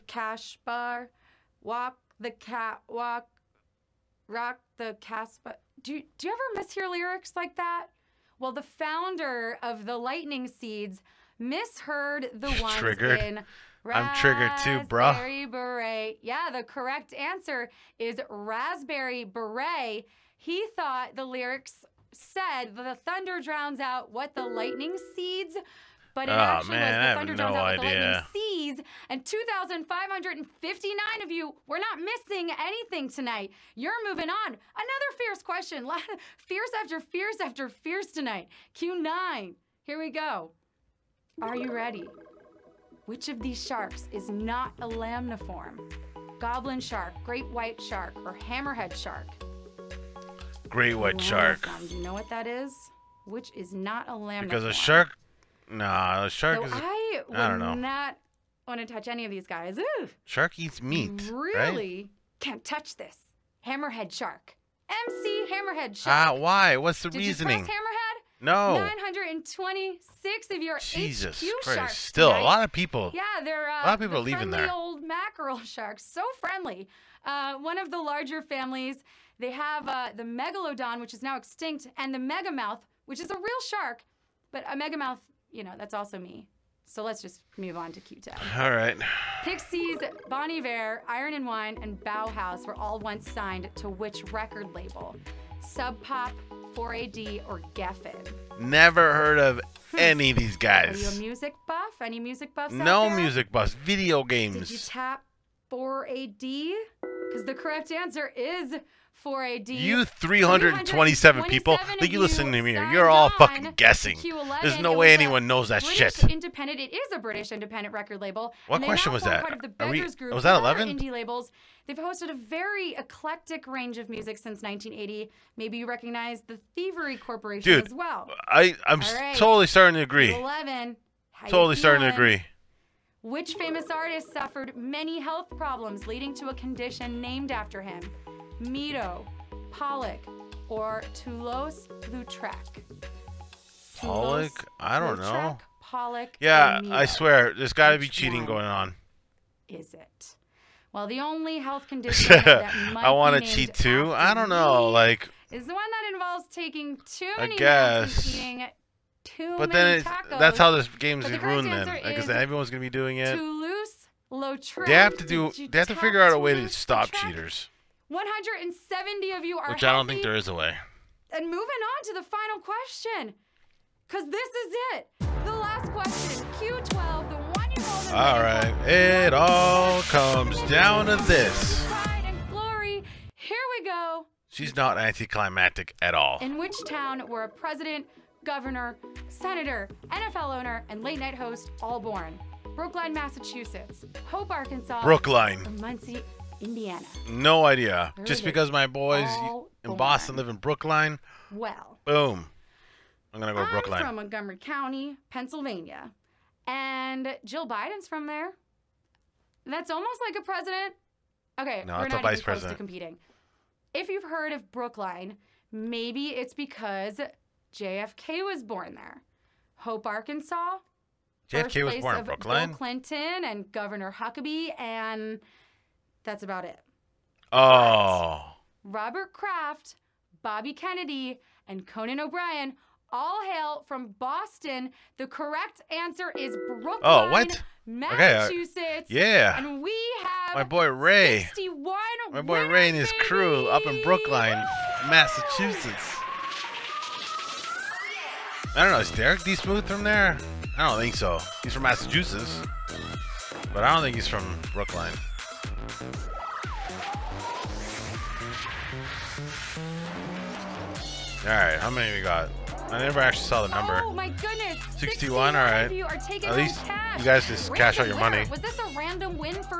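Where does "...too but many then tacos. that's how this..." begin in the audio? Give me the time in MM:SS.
02:39.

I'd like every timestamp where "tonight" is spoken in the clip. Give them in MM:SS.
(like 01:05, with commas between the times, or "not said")
00:33, 00:38, 01:12.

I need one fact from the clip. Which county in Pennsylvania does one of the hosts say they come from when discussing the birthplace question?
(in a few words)
Montgomery County.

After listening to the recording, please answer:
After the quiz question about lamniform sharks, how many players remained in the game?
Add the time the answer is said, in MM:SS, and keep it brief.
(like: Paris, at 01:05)
926, at 01:08.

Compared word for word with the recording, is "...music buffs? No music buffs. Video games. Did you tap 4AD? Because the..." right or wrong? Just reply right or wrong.
right.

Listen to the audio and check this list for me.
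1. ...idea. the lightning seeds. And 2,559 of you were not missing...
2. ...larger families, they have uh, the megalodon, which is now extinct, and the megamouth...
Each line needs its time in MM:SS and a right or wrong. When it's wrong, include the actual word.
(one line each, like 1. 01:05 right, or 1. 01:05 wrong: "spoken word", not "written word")
1. 00:27 right
2. 01:18 right.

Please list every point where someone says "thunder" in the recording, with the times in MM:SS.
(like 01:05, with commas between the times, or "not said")
00:23, 00:27.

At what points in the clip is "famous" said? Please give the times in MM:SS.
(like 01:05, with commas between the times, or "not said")
02:13.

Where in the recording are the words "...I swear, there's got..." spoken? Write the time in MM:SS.
02:26.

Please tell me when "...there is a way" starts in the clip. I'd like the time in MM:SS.
02:50.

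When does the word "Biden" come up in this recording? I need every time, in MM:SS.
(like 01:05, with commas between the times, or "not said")
03:27.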